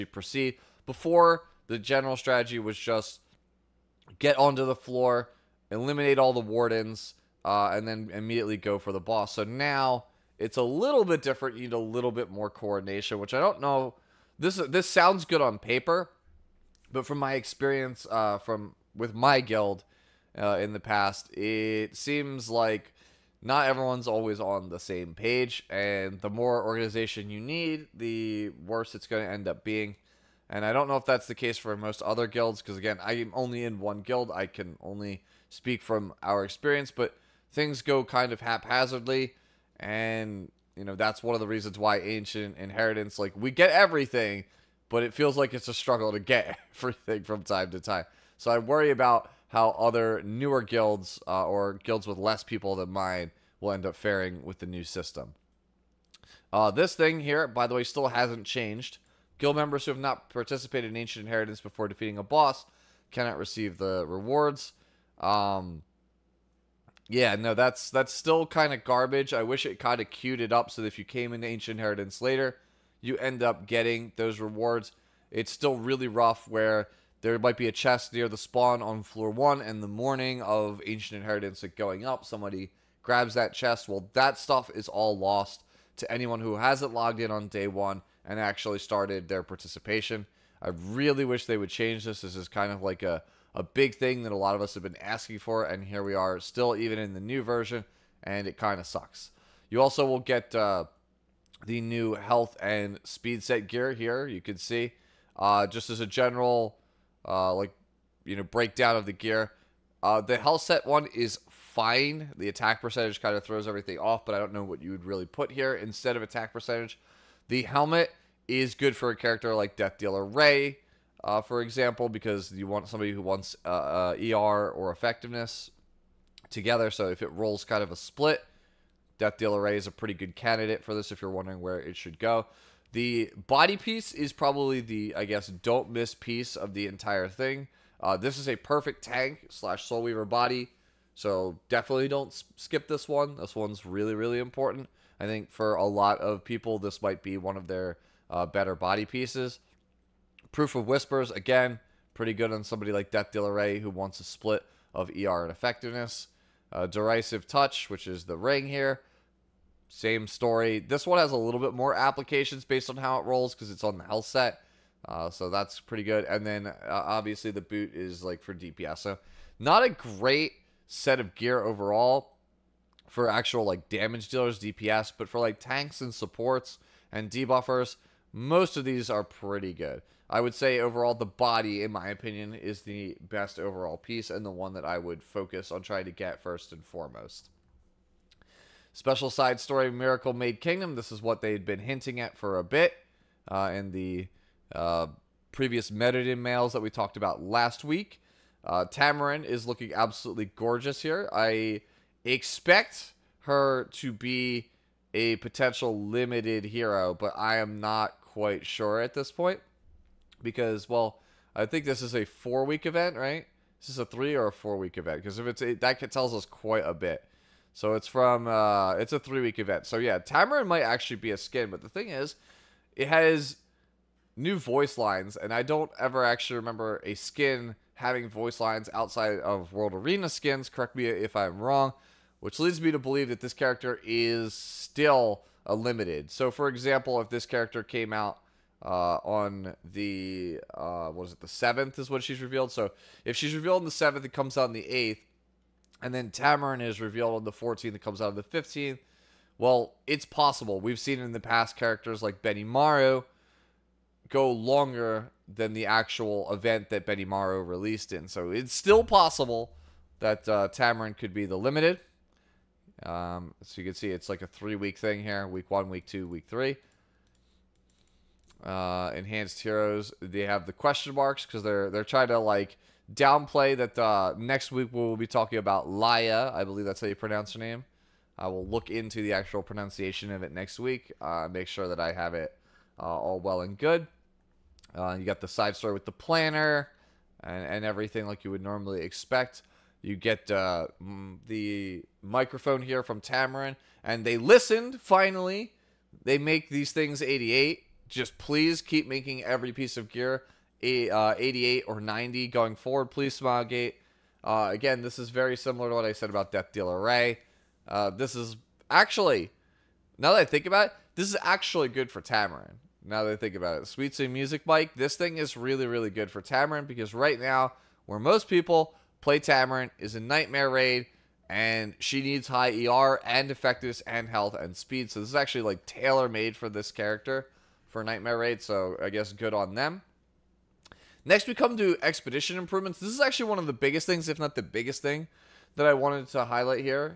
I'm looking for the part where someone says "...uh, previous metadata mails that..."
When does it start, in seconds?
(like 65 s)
194 s.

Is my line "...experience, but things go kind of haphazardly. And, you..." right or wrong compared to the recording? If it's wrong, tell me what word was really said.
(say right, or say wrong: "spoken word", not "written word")
right.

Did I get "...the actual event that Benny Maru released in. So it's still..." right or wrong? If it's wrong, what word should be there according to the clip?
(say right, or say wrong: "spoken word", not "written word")
right.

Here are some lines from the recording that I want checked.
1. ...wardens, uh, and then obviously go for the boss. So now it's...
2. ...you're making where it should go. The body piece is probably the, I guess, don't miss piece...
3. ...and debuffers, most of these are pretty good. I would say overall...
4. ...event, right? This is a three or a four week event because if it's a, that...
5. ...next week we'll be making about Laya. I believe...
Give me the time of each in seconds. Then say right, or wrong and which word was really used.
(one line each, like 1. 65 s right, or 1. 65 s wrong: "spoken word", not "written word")
1. 6 s wrong: "immediately", not "obviously"
2. 131 s wrong: "wondering", not "making"
3. 177 s right
4. 212 s right
5. 274 s wrong: "talking", not "making".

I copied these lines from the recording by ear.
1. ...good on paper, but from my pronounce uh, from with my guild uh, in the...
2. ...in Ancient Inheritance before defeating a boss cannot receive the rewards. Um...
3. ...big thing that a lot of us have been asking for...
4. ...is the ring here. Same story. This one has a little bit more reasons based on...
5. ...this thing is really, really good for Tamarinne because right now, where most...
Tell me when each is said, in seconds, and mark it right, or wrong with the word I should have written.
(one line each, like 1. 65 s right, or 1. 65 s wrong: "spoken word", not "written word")
1. 15 s wrong: "experience", not "pronounce"
2. 60 s right
3. 93 s right
4. 158 s wrong: "applications", not "reasons"
5. 314 s right.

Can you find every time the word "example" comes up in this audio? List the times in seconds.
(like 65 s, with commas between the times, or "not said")
121 s, 236 s.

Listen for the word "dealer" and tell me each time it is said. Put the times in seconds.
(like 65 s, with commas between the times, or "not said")
119 s, 129 s, 153 s, 174 s, 306 s.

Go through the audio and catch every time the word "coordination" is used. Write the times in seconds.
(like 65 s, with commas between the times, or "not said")
12 s.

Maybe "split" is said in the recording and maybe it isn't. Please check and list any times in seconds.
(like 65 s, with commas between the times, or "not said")
127 s, 154 s.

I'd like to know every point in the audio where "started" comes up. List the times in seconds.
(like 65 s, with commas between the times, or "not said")
88 s.